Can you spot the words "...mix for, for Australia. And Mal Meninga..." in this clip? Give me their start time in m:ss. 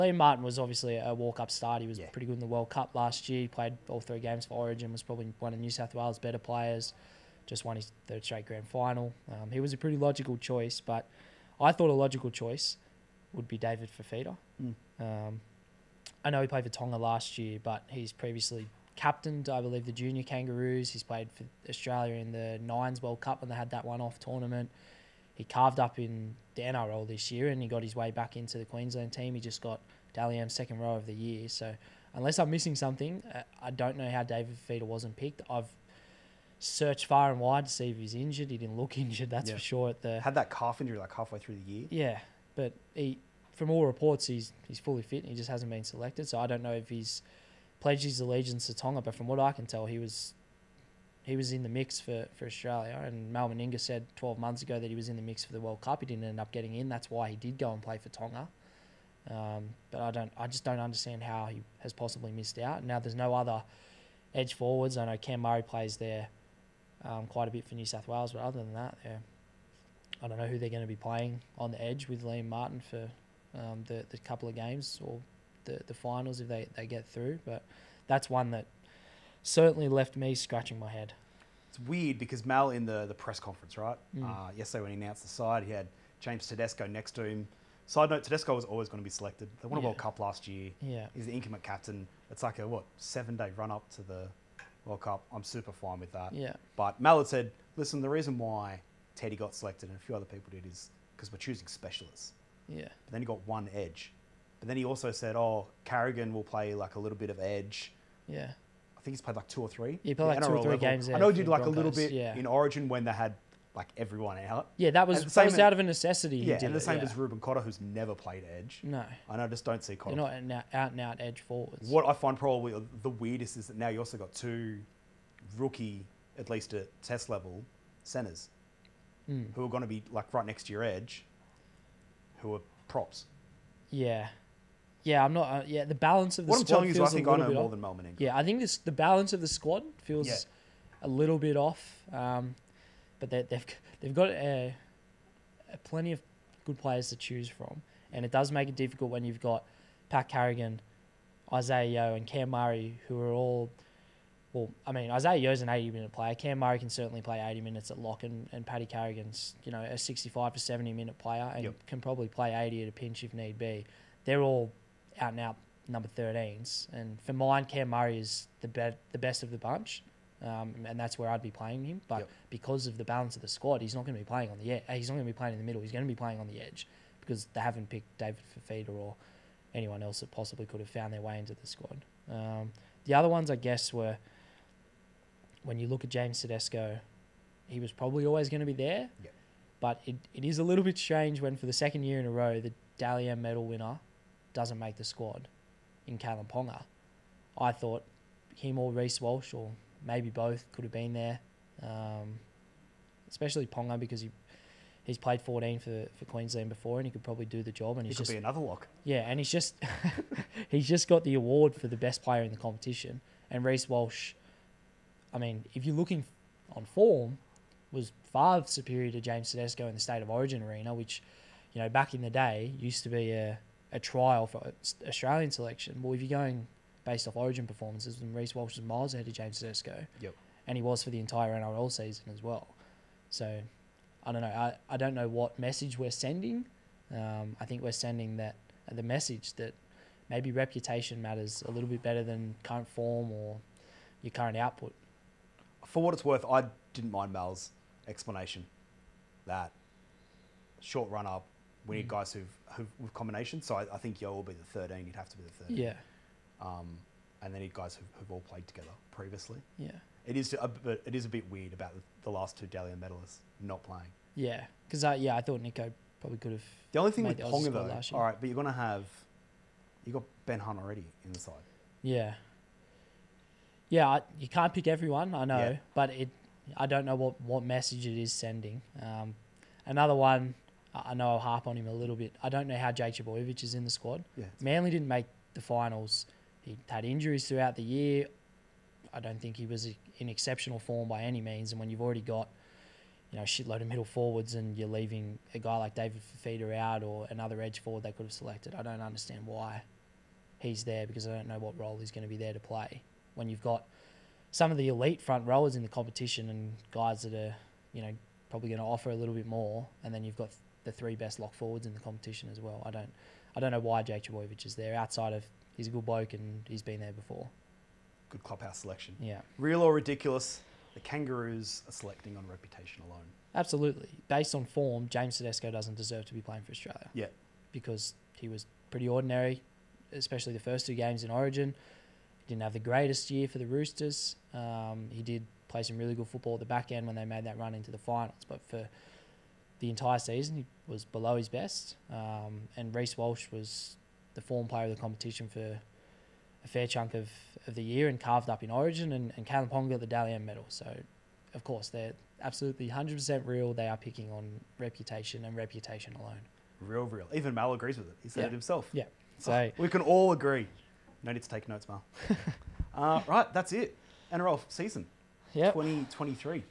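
0:51.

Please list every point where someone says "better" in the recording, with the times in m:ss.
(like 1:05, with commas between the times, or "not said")
0:06, 4:02.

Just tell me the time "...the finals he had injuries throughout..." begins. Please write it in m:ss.
4:45.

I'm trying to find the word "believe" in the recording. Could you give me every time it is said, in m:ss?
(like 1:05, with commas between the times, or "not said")
0:19.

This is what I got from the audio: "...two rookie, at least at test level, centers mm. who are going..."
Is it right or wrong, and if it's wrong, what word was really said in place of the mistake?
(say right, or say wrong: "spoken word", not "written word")
right.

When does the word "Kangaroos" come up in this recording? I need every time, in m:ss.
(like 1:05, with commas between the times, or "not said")
0:20, 5:20.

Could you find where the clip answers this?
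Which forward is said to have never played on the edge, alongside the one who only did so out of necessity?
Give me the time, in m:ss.
1:57.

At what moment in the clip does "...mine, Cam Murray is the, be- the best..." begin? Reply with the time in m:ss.
2:47.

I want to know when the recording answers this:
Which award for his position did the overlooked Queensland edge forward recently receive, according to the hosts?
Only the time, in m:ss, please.
0:30.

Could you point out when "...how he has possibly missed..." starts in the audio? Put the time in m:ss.
1:01.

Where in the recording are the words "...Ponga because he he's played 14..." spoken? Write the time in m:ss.
3:23.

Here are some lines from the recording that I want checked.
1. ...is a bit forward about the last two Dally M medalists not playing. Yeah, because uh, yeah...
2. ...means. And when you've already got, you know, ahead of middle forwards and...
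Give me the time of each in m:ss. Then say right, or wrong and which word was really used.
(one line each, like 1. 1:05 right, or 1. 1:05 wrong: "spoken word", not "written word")
1. 4:21 wrong: "weird", not "forward"
2. 4:51 wrong: "shitload", not "ahead".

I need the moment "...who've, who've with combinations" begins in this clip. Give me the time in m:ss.
4:12.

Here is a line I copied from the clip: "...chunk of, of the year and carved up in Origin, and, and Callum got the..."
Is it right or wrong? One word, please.
right.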